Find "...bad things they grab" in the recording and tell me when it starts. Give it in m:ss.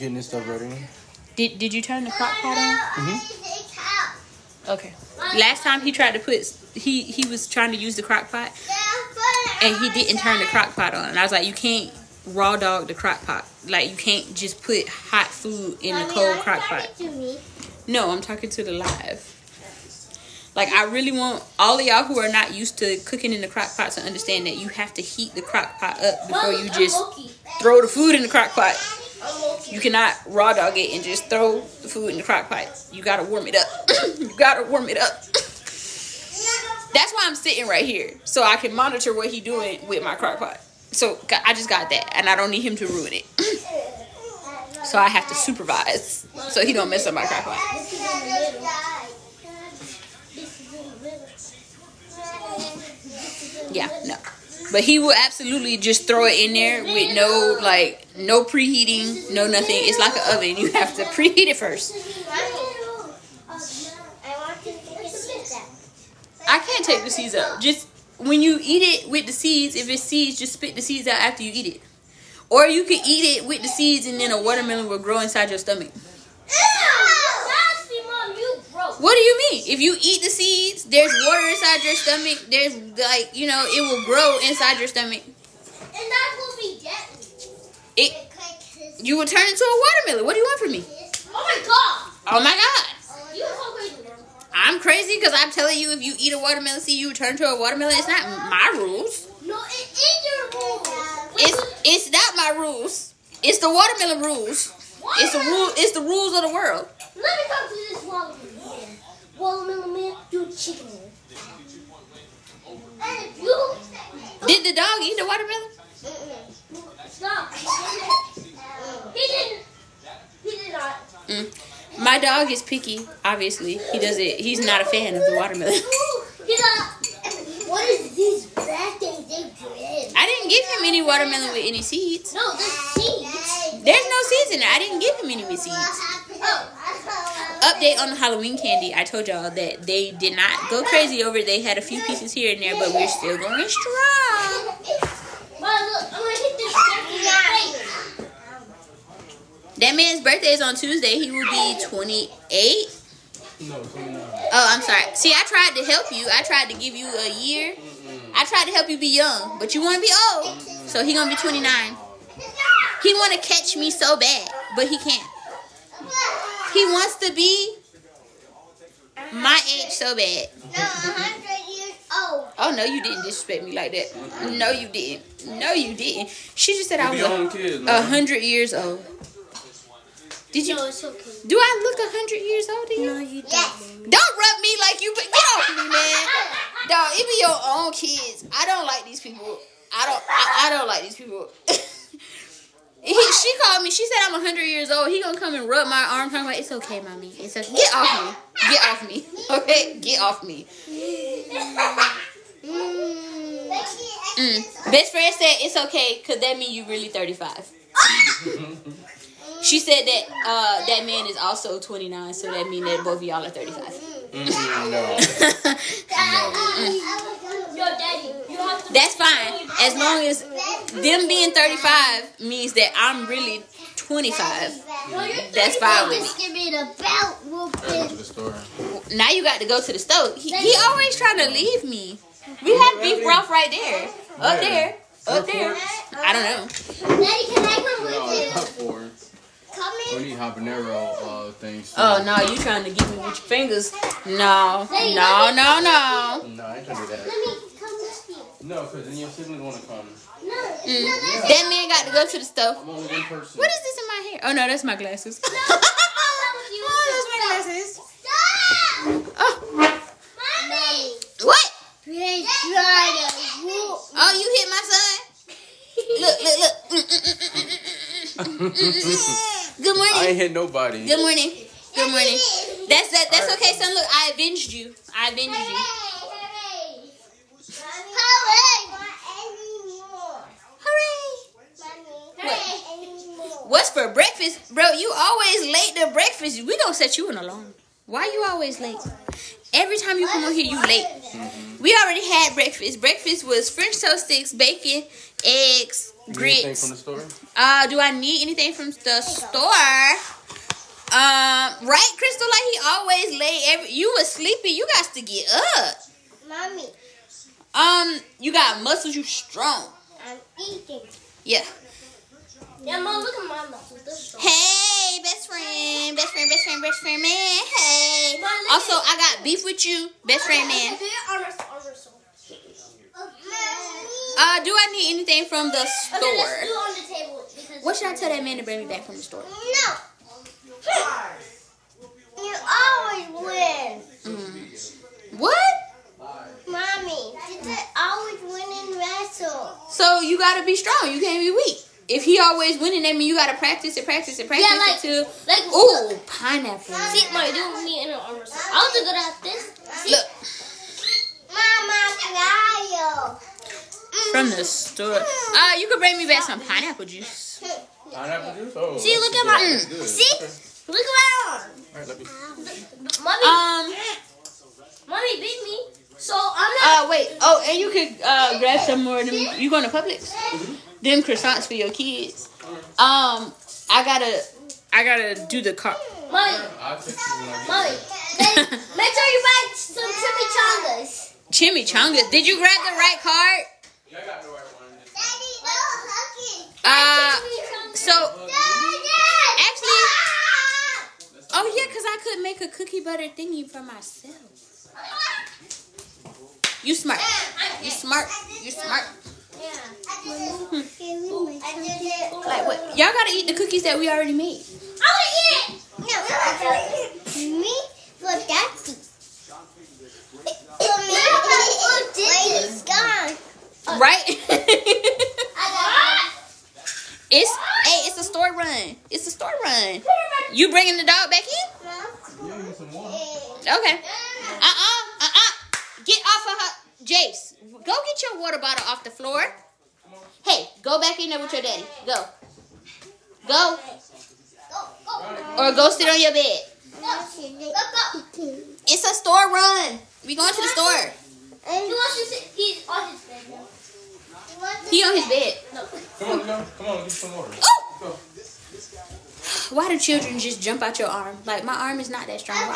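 2:08.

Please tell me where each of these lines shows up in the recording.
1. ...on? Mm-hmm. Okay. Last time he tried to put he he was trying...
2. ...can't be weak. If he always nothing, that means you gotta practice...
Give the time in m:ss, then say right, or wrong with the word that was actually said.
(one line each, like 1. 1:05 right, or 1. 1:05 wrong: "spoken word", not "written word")
1. 0:02 right
2. 5:41 wrong: "winning", not "nothing".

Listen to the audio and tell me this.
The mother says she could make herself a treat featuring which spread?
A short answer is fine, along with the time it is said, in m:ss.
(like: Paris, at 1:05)
cookie butter, at 6:32.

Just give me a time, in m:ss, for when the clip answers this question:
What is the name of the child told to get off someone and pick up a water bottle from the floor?
7:07.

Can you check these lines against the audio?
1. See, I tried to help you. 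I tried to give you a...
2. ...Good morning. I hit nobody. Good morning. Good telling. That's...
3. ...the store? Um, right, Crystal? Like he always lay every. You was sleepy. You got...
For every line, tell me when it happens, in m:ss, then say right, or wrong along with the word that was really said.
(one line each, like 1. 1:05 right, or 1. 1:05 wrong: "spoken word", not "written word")
1. 2:35 right
2. 4:28 wrong: "morning", not "telling"
3. 4:58 right.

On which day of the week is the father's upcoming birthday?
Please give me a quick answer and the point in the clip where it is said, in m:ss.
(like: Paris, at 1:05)
Tuesday, at 2:30.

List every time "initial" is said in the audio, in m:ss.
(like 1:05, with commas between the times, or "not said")
not said.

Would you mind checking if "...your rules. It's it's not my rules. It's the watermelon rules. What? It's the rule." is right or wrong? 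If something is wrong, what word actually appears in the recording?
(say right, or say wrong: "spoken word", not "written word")
right.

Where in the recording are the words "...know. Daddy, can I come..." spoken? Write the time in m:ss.
3:56.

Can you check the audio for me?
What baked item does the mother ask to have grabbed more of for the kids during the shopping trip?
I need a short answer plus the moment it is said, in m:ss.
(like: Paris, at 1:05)
croissants, at 6:11.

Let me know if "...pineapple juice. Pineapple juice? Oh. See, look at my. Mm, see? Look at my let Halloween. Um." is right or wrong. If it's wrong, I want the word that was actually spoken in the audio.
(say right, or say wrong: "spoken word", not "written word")
wrong: "Mommy", not "Halloween".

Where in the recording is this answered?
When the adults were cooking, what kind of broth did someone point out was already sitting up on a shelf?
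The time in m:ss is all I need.
3:53.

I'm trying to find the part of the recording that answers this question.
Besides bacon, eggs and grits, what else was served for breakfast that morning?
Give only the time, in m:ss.
4:53.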